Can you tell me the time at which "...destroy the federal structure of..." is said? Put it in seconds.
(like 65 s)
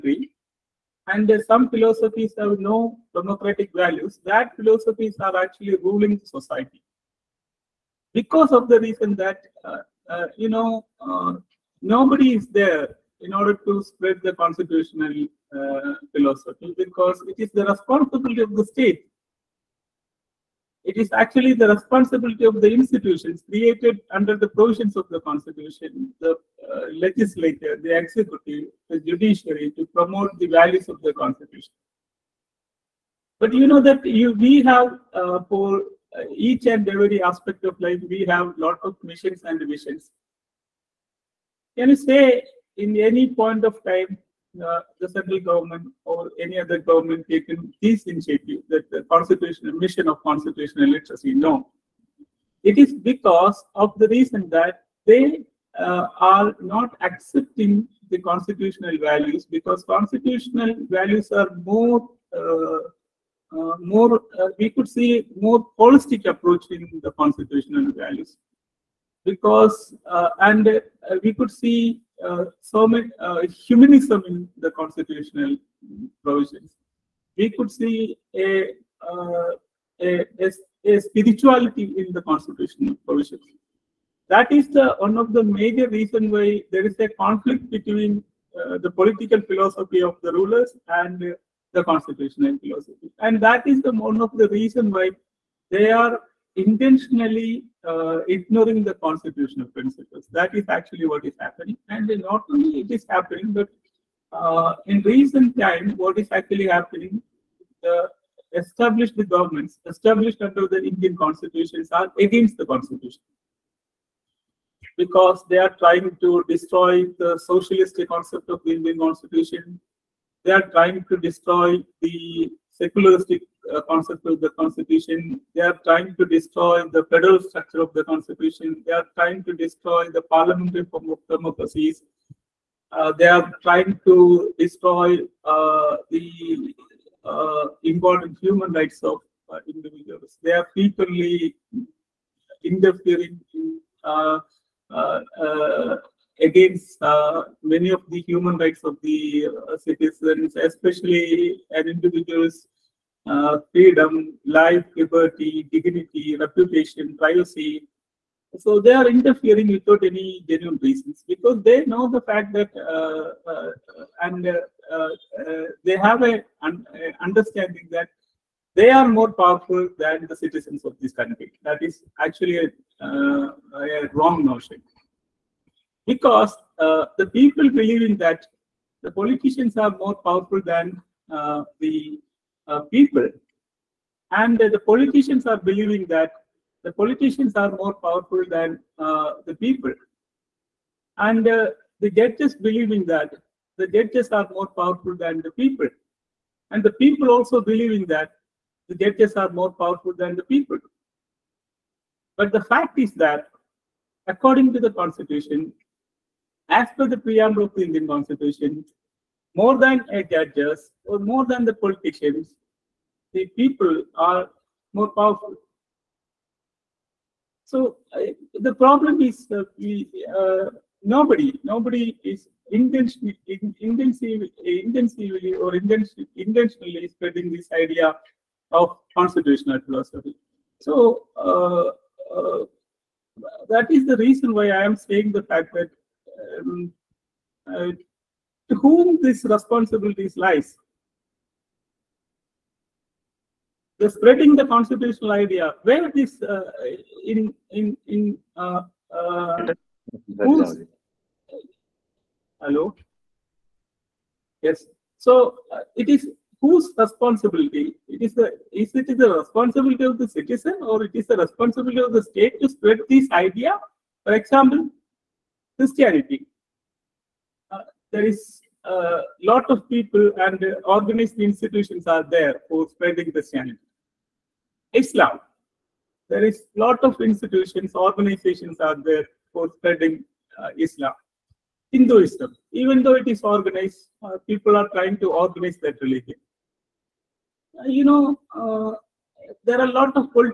126 s.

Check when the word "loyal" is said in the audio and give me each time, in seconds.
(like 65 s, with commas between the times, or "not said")
not said.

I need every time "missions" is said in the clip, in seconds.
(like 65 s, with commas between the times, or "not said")
39 s, 49 s.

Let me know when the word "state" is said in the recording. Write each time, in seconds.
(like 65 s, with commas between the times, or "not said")
18 s, 262 s.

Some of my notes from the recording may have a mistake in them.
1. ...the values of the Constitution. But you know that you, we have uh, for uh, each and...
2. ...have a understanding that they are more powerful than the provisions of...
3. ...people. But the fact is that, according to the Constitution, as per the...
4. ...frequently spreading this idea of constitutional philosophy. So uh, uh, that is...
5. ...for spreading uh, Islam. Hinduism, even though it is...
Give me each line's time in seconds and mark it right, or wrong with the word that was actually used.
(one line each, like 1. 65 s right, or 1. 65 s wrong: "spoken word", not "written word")
1. 30 s right
2. 165 s wrong: "citizens", not "provisions"
3. 200 s right
4. 226 s wrong: "intentionally", not "frequently"
5. 279 s right.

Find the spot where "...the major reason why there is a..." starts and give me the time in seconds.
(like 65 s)
85 s.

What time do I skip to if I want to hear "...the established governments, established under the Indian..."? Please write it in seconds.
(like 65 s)
107 s.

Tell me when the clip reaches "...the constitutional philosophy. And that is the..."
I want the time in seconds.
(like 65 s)
91 s.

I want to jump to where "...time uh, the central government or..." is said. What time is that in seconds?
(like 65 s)
43 s.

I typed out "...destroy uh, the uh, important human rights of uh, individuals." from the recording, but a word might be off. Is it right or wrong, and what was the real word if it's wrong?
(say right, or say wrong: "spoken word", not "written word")
right.